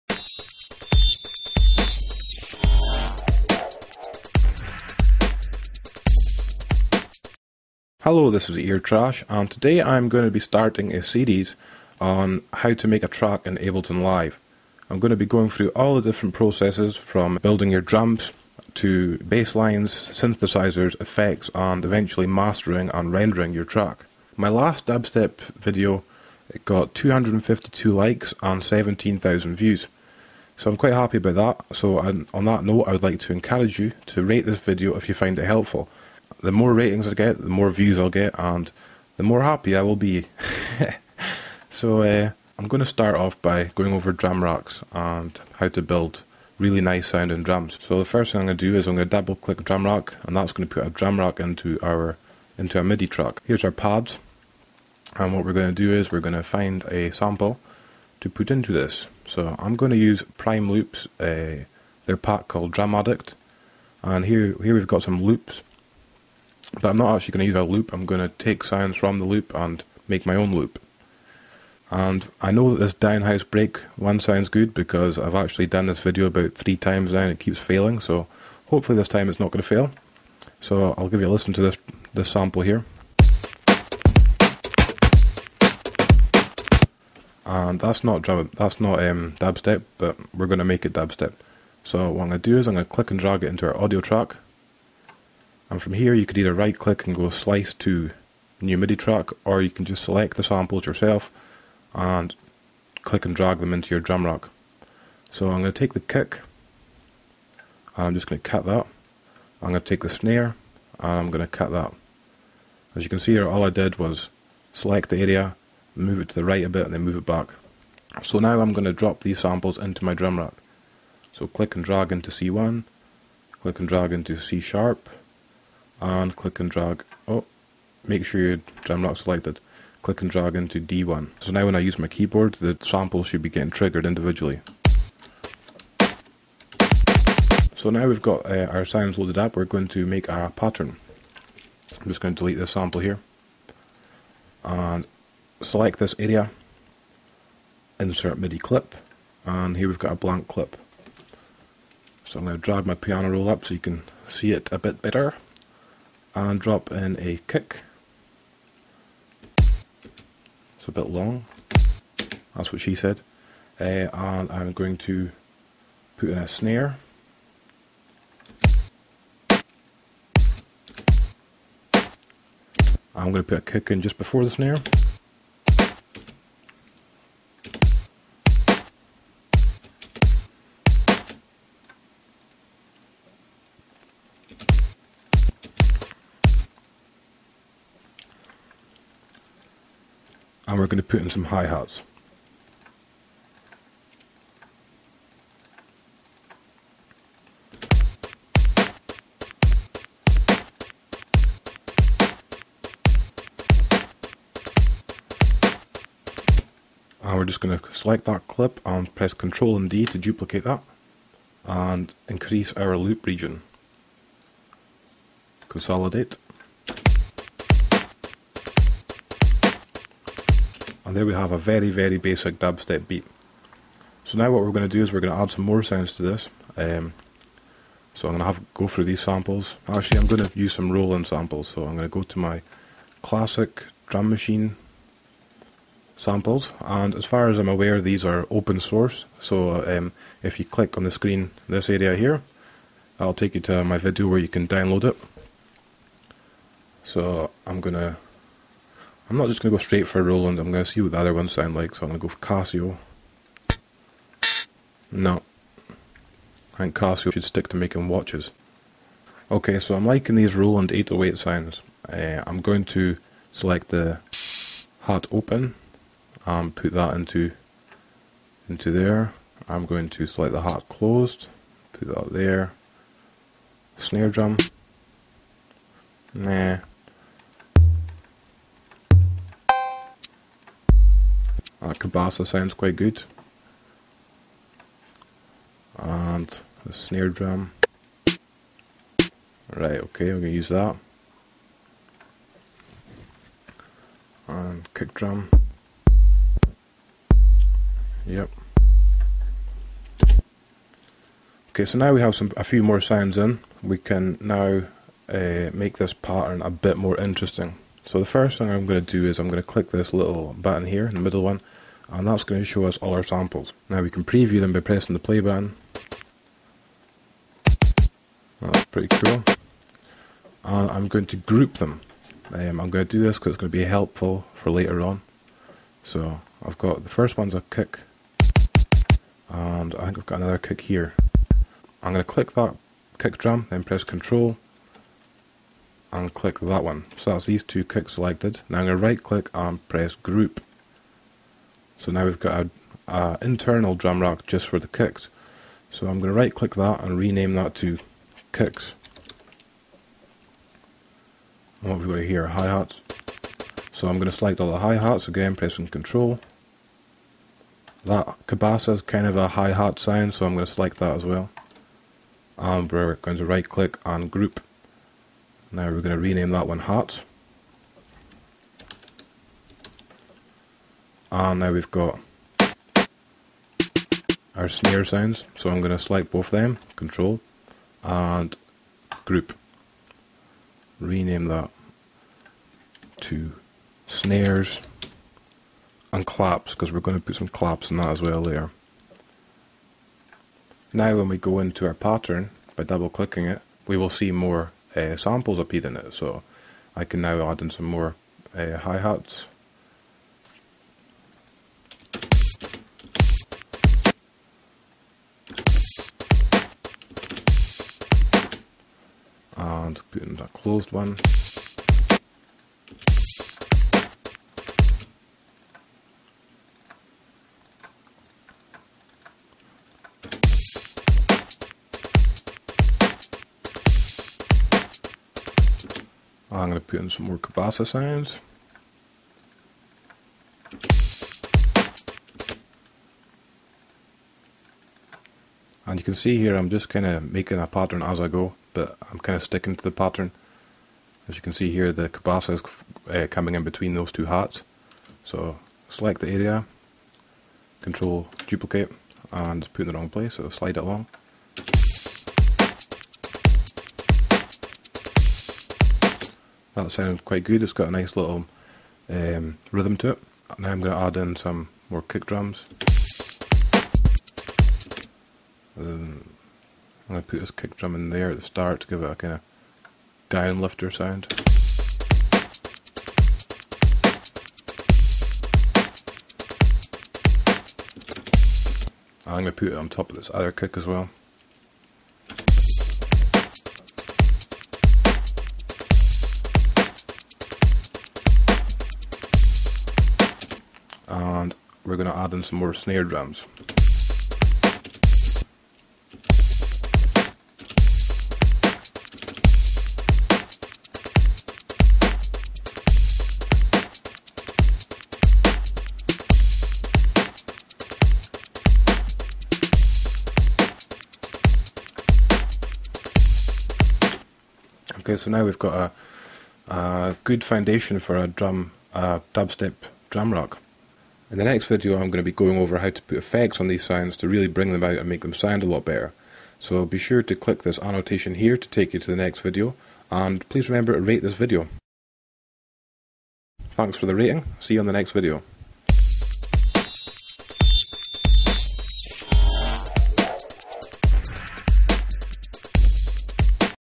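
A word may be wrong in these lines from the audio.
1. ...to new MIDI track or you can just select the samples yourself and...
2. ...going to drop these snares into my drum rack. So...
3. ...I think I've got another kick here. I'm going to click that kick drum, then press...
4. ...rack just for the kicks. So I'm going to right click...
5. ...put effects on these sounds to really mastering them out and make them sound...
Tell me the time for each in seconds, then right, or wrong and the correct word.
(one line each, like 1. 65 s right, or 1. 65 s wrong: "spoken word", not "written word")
1. 97 s right
2. 118 s wrong: "samples", not "snares"
3. 329 s right
4. 344 s right
5. 523 s wrong: "bring", not "mastering".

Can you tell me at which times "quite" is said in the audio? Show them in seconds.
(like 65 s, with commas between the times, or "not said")
30 s, 282 s, 457 s.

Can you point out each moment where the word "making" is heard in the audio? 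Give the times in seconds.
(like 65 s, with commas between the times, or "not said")
257 s, 437 s.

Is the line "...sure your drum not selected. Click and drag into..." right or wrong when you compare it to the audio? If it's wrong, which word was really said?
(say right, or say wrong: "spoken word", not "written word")
right.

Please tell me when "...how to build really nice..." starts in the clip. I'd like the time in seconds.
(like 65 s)
45 s.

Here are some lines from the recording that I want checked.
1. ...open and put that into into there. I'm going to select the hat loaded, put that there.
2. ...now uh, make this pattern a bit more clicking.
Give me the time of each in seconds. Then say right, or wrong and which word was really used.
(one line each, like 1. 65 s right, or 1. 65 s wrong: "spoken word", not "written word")
1. 265 s wrong: "closed", not "loaded"
2. 304 s wrong: "interesting", not "clicking".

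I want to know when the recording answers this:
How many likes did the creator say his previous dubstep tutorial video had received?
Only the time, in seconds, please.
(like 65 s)
26 s.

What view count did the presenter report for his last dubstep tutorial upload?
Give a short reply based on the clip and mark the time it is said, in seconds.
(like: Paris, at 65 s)
17,000, at 28 s.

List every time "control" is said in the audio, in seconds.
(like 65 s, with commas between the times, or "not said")
334 s, 355 s, 376 s, 447 s.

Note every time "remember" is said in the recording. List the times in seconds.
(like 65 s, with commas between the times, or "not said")
530 s.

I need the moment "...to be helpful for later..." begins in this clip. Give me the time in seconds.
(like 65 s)
323 s.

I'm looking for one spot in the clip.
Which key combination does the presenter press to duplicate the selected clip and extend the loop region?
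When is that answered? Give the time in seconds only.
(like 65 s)
209 s.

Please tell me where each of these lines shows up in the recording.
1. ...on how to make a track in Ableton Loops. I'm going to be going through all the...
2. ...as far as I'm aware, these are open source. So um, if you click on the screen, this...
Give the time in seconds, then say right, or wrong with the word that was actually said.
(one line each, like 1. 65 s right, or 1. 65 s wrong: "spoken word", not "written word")
1. 11 s wrong: "Live", not "Loops"
2. 237 s right.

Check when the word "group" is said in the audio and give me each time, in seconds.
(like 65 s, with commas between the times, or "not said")
321 s, 340 s, 364 s, 379 s.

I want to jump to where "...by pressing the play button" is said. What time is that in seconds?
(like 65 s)
314 s.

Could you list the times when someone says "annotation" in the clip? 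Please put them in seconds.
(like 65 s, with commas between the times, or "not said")
527 s.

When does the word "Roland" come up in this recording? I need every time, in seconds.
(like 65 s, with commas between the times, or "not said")
230 s, 250 s, 260 s.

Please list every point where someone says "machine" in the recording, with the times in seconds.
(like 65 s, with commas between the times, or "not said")
234 s.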